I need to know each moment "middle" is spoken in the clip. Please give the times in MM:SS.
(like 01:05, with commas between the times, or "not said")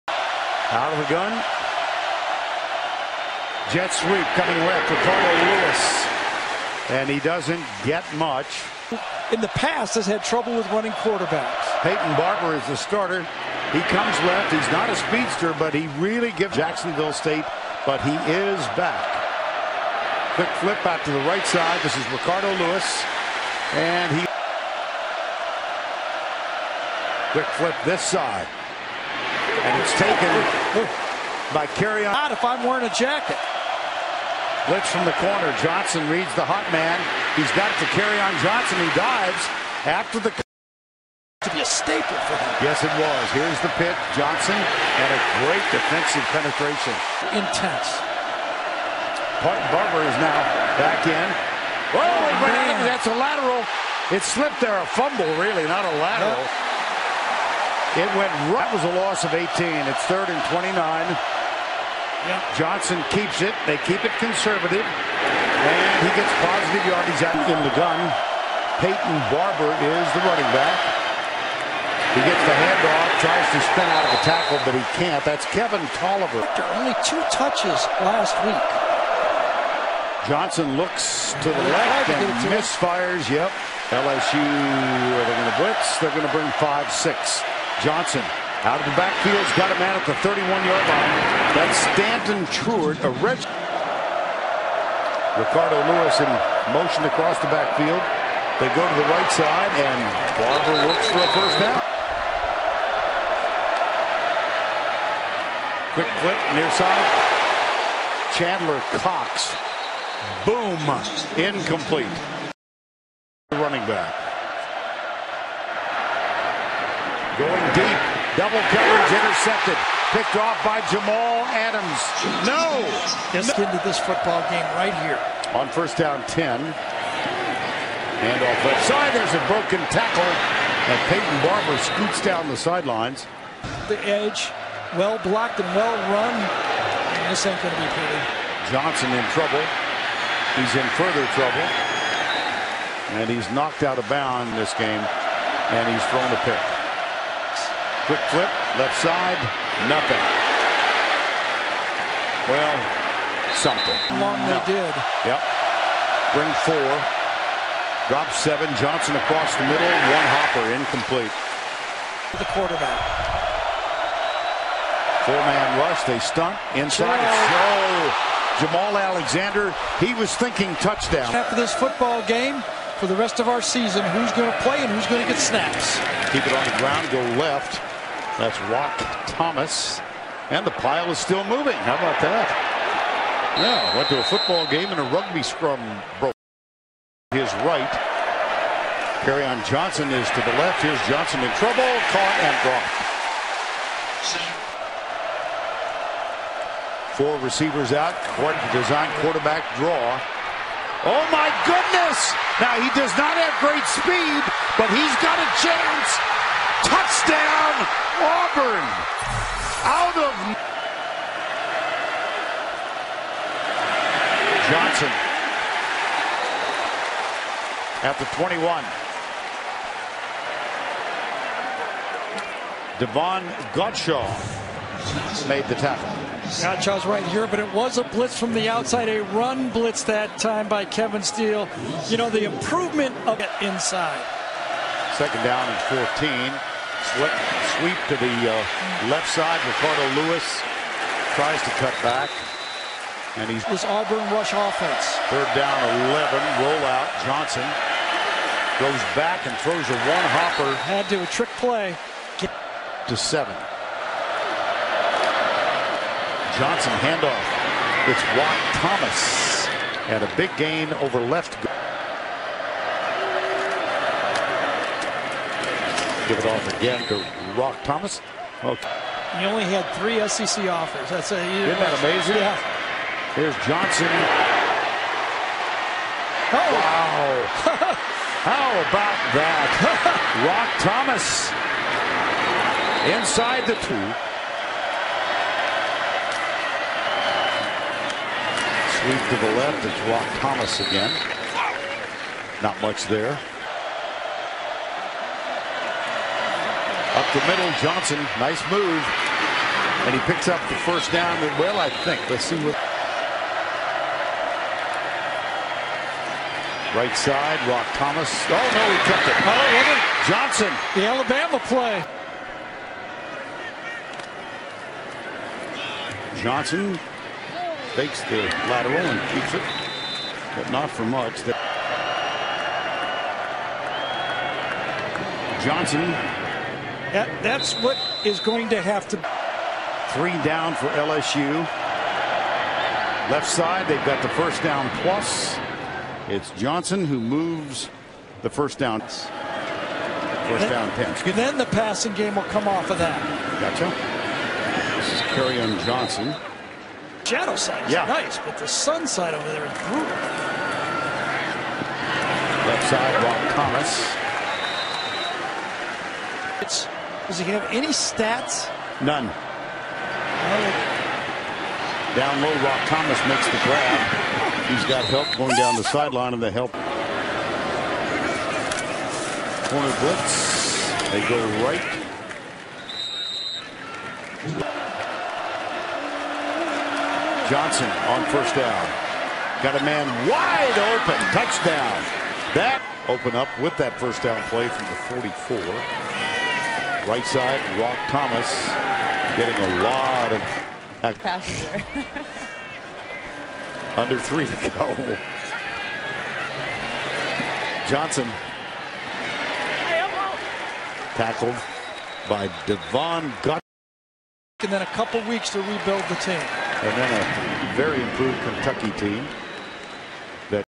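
02:39, 04:57.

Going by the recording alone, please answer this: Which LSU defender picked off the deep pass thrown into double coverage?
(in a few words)
Jamal Adams.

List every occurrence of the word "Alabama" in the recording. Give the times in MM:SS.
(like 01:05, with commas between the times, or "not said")
05:11.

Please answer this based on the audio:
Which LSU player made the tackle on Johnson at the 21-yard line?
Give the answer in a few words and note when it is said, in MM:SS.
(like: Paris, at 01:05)
Davon Godchaux, at 03:42.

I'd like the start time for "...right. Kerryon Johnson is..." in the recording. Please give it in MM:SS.
03:07.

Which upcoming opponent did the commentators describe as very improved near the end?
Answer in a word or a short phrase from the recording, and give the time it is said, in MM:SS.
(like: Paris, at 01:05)
Kentucky, at 06:48.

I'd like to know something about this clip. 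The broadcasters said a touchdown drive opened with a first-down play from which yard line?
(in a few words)
44.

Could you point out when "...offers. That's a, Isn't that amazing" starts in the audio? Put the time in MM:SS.
04:30.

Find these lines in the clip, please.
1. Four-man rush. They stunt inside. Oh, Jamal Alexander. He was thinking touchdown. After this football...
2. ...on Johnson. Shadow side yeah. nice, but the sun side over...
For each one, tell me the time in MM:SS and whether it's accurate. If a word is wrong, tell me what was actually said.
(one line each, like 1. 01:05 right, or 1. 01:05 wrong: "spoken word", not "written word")
1. 02:45 right
2. 05:45 right.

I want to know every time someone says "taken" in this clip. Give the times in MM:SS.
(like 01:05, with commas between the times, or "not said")
00:29.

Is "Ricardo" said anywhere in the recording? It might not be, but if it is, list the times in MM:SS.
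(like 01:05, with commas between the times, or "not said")
00:22, 01:35, 03:59.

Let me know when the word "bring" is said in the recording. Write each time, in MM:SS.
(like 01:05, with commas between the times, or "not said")
01:26, 02:36.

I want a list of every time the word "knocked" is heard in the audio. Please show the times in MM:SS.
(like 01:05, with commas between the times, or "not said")
02:23.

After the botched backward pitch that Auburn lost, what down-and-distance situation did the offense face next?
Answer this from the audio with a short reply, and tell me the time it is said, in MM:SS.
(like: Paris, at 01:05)
third and 29, at 01:00.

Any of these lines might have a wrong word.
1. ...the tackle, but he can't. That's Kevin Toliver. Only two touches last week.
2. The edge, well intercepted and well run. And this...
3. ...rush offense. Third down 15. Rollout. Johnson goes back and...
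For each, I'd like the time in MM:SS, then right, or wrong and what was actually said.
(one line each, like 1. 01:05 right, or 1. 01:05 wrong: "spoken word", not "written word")
1. 01:14 right
2. 02:13 wrong: "blocked", not "intercepted"
3. 04:04 wrong: "11", not "15".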